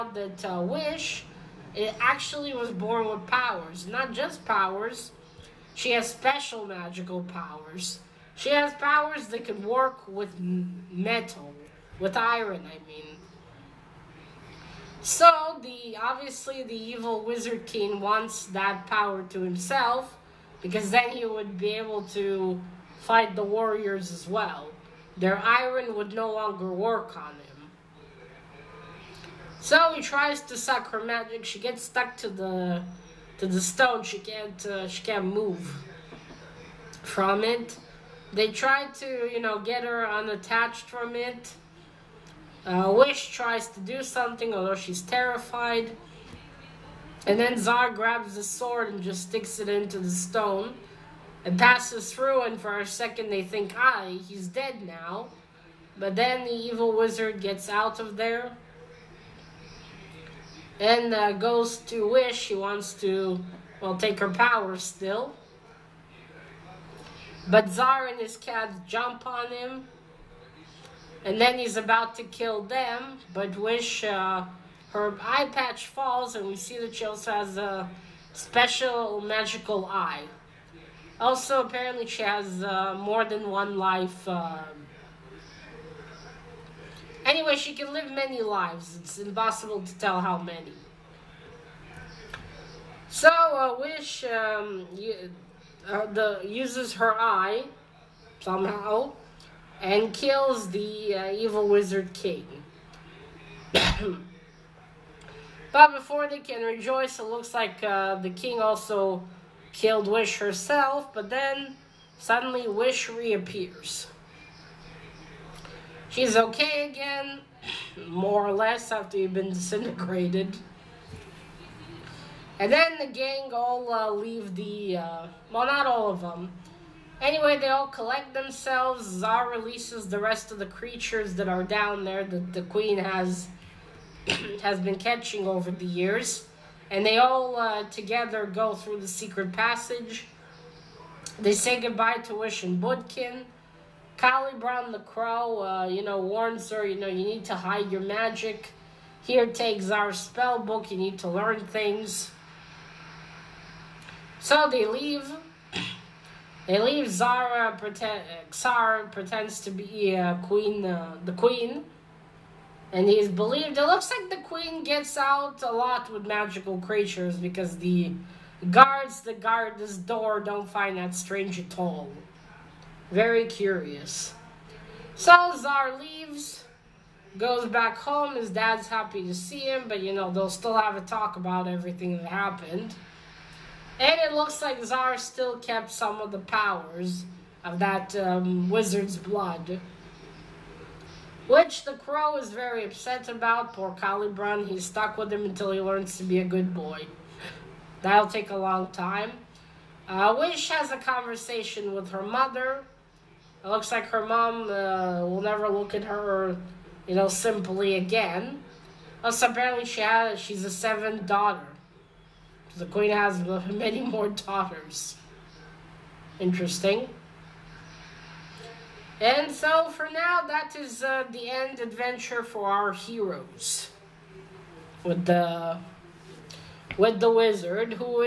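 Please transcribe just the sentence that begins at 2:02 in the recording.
And then the gang all uh, leave the, uh, well, not all of them, Anyway, they all collect themselves.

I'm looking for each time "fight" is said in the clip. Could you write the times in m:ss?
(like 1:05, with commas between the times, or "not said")
0:23.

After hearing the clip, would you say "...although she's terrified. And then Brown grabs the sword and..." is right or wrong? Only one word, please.
wrong.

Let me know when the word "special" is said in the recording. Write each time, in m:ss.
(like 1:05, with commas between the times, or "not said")
0:06, 1:18.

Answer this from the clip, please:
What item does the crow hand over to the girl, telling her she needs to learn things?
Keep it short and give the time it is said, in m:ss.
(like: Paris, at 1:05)
Spell book, at 2:30.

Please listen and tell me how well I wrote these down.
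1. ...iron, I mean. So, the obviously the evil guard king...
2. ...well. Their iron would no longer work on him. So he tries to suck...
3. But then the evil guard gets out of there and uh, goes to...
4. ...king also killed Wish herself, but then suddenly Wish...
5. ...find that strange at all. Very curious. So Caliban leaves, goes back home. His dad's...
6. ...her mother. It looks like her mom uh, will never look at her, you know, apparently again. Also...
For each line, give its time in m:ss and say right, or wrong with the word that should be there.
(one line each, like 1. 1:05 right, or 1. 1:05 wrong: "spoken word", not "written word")
1. 0:12 wrong: "wizard", not "guard"
2. 0:24 right
3. 0:55 wrong: "wizard", not "guard"
4. 1:48 right
5. 2:50 wrong: "Zara", not "Caliban"
6. 3:22 wrong: "simply", not "apparently".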